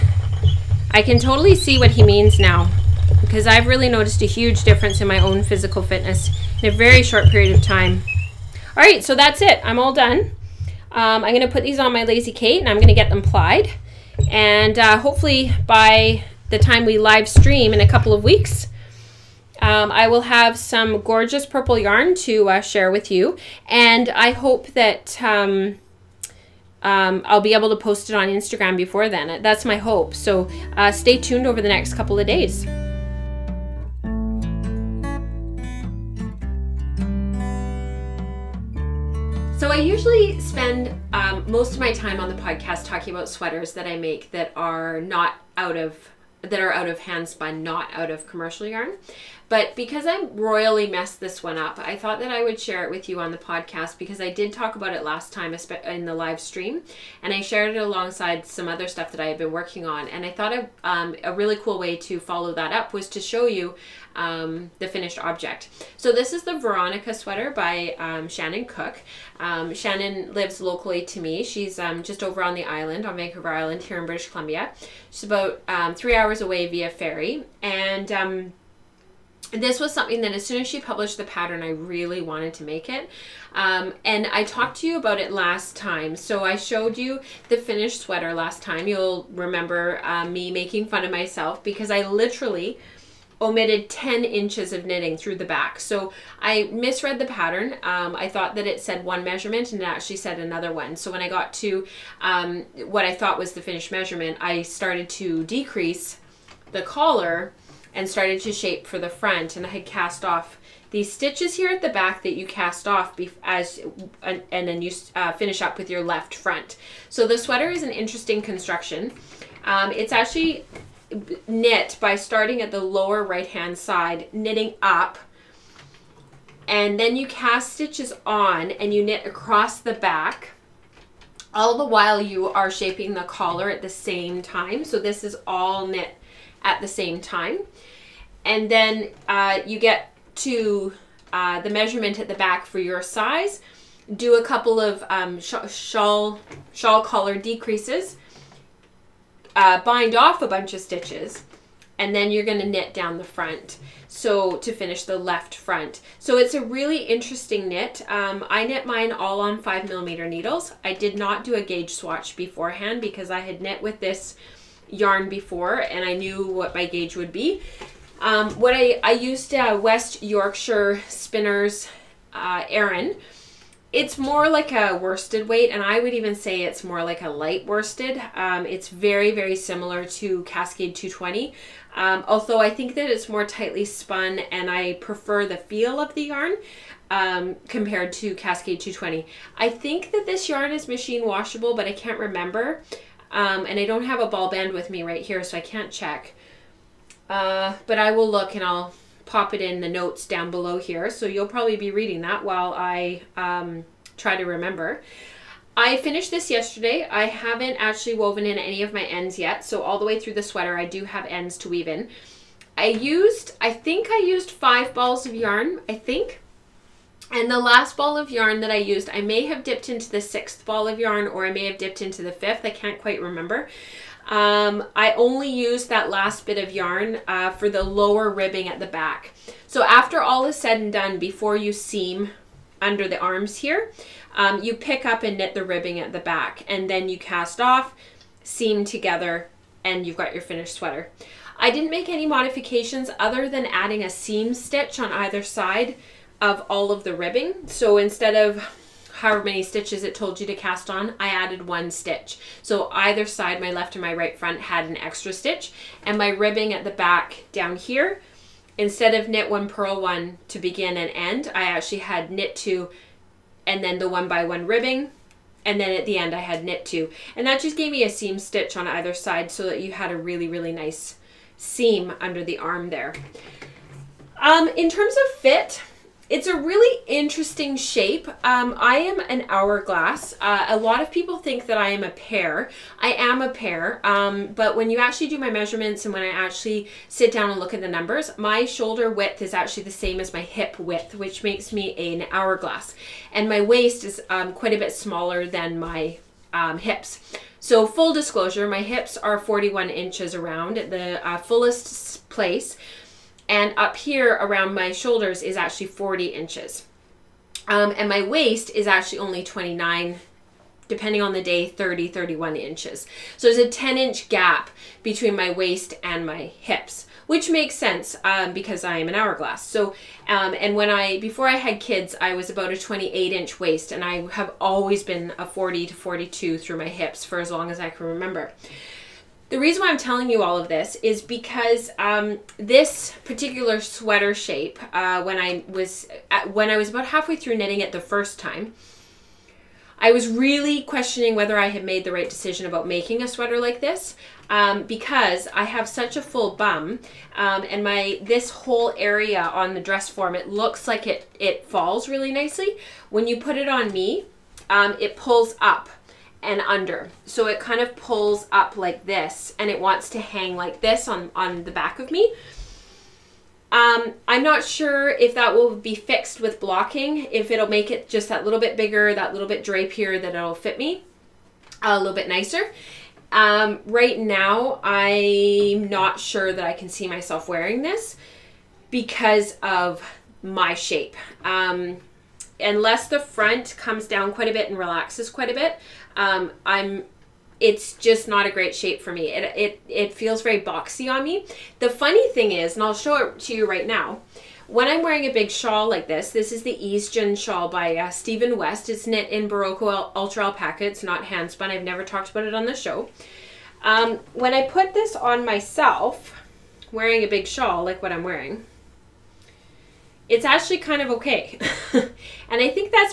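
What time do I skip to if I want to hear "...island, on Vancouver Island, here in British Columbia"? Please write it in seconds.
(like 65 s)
72 s.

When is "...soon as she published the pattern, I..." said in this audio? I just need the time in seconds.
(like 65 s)
80 s.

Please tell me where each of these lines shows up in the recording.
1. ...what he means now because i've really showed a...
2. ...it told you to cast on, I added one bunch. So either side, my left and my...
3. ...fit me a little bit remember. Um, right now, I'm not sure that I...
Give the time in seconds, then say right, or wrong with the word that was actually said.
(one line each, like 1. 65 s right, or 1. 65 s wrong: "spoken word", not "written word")
1. 1 s wrong: "noticed", not "showed"
2. 250 s wrong: "stitch", not "bunch"
3. 370 s wrong: "nicer", not "remember".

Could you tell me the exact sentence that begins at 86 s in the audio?
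So I showed you the finished sweater last time.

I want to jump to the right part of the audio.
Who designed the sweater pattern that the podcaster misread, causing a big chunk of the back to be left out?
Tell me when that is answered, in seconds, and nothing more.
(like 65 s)
68 s.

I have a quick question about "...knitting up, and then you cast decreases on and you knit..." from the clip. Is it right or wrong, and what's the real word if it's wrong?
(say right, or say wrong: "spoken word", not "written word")
wrong: "stitches", not "decreases".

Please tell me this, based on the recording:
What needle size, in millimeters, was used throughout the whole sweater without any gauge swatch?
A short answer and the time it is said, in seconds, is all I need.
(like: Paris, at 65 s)
5, at 159 s.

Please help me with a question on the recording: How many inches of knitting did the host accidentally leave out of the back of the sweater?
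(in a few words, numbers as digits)
10.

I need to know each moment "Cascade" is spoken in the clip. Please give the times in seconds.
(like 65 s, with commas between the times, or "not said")
180 s, 188 s.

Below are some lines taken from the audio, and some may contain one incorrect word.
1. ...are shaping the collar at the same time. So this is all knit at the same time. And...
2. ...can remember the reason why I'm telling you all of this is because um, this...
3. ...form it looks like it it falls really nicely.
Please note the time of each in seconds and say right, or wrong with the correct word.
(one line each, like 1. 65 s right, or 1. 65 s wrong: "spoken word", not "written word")
1. 132 s right
2. 327 s right
3. 350 s right.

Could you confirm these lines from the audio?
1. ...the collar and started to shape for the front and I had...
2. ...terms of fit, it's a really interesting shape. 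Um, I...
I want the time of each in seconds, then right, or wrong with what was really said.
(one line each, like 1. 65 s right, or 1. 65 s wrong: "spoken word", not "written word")
1. 106 s right
2. 274 s right.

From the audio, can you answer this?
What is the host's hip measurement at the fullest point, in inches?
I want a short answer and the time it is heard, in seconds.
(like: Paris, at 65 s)
41, at 299 s.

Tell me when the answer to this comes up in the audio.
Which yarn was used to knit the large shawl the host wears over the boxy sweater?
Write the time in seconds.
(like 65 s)
399 s.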